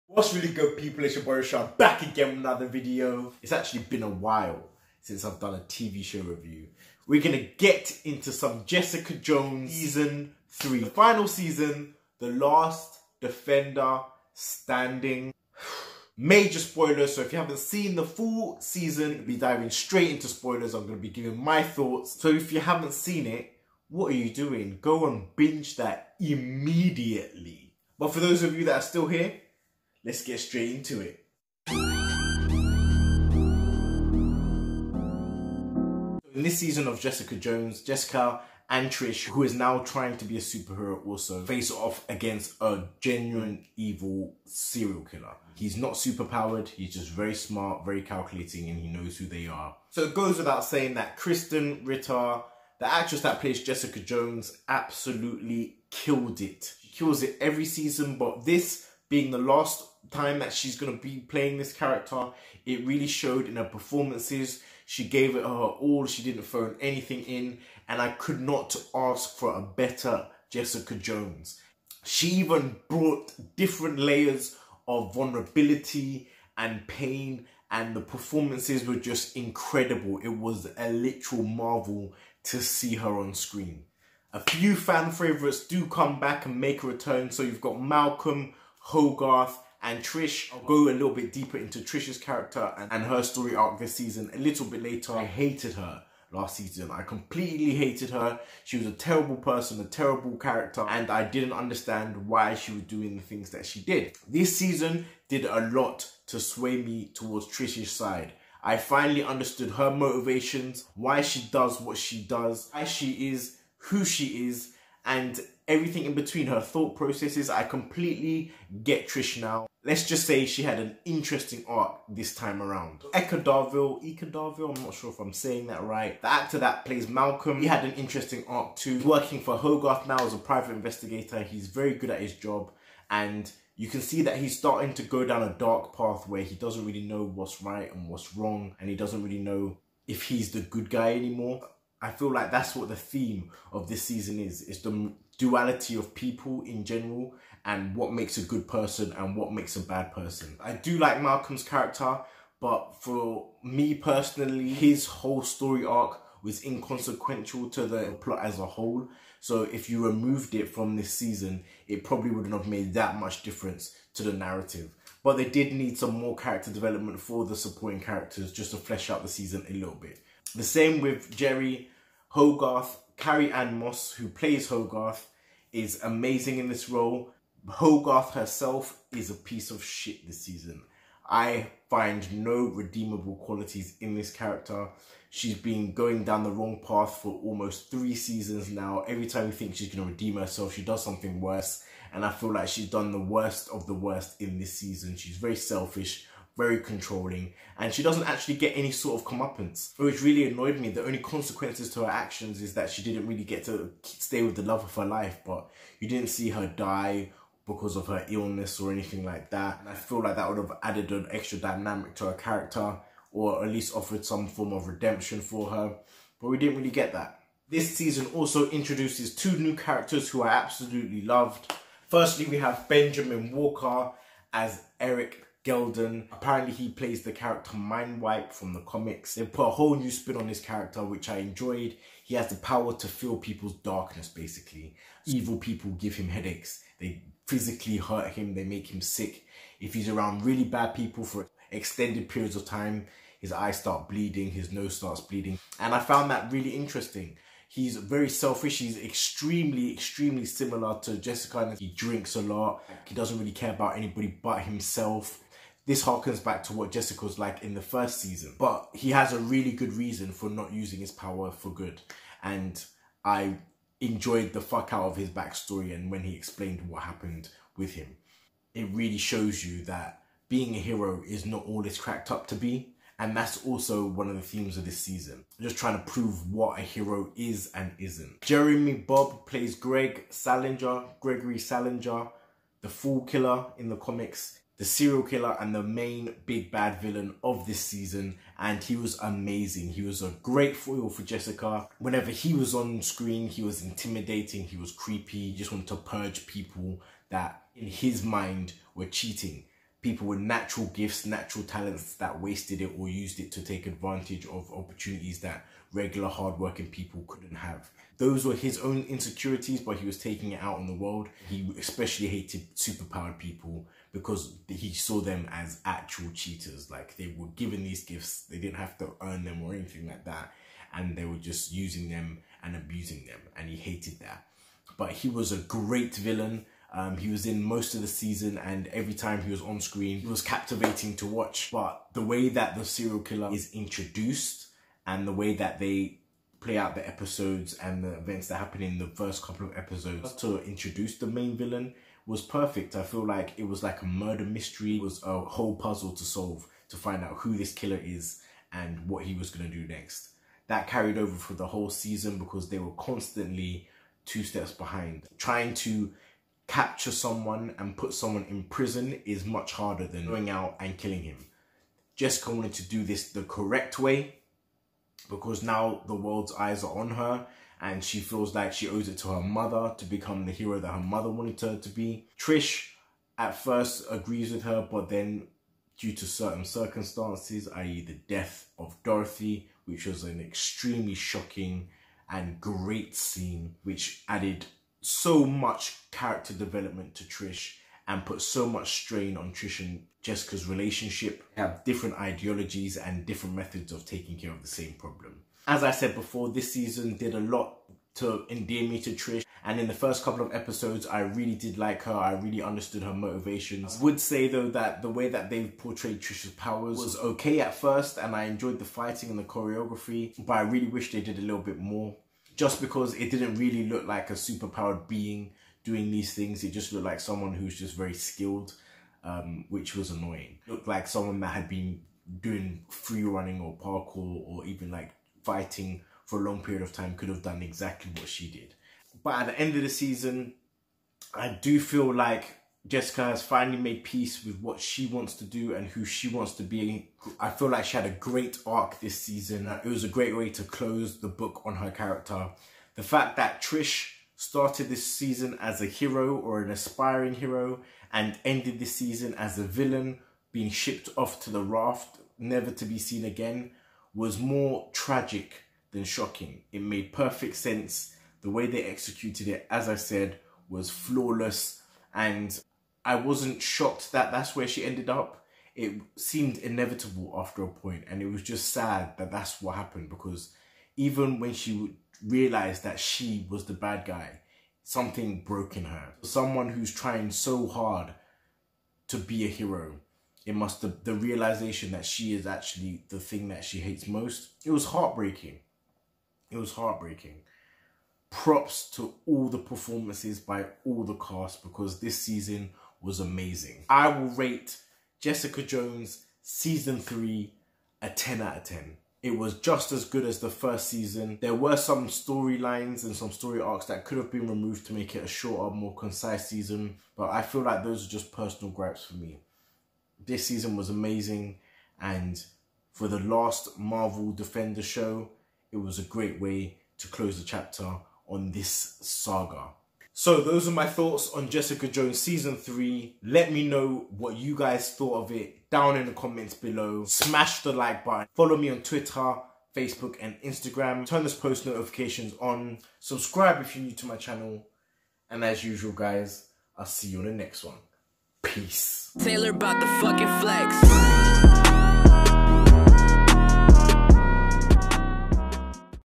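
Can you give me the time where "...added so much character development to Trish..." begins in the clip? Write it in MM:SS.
06:24.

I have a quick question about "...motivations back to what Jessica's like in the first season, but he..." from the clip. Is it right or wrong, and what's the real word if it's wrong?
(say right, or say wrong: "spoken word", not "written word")
wrong: "harkens", not "motivations".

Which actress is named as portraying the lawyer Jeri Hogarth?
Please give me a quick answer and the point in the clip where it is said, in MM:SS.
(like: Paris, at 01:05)
Carrie Ann Moss, at 02:53.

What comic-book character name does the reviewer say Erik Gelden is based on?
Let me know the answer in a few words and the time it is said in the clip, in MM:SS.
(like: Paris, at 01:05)
Mindwipe, at 03:47.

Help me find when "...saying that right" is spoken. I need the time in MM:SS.
02:05.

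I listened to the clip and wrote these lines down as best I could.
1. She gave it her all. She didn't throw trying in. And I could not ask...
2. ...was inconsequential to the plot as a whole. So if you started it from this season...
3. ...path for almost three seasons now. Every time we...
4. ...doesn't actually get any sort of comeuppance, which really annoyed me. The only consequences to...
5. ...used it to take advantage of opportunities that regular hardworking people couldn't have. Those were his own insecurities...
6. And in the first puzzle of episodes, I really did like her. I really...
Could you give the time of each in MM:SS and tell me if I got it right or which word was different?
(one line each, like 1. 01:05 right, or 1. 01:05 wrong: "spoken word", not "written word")
1. 01:04 wrong: "anything", not "trying"
2. 02:36 wrong: "removed", not "started"
3. 03:06 right
4. 03:18 right
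5. 05:03 right
6. 06:39 wrong: "couple", not "puzzle".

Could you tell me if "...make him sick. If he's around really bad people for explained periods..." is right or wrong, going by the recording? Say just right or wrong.
wrong.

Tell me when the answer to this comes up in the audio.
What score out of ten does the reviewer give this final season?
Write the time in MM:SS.
08:18.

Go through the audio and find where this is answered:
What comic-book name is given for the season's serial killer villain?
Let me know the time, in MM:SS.
04:42.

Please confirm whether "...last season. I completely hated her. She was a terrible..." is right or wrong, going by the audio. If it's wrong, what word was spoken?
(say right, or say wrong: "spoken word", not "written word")
right.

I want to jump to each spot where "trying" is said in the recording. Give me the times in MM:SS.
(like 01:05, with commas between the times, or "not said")
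00:39, 04:35, 05:55, 07:56.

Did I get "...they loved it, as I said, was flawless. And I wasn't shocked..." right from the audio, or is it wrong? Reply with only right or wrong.
wrong.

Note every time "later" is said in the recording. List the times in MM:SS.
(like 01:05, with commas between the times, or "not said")
01:34.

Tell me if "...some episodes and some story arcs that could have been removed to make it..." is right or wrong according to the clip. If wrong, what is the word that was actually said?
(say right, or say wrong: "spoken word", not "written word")
wrong: "storylines", not "episodes".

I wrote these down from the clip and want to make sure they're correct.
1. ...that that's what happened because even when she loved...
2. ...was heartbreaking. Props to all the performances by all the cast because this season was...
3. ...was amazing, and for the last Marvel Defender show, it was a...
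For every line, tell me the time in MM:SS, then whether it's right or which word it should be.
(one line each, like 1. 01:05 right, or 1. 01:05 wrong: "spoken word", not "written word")
1. 07:49 wrong: "realized", not "loved"
2. 08:06 right
3. 08:30 right.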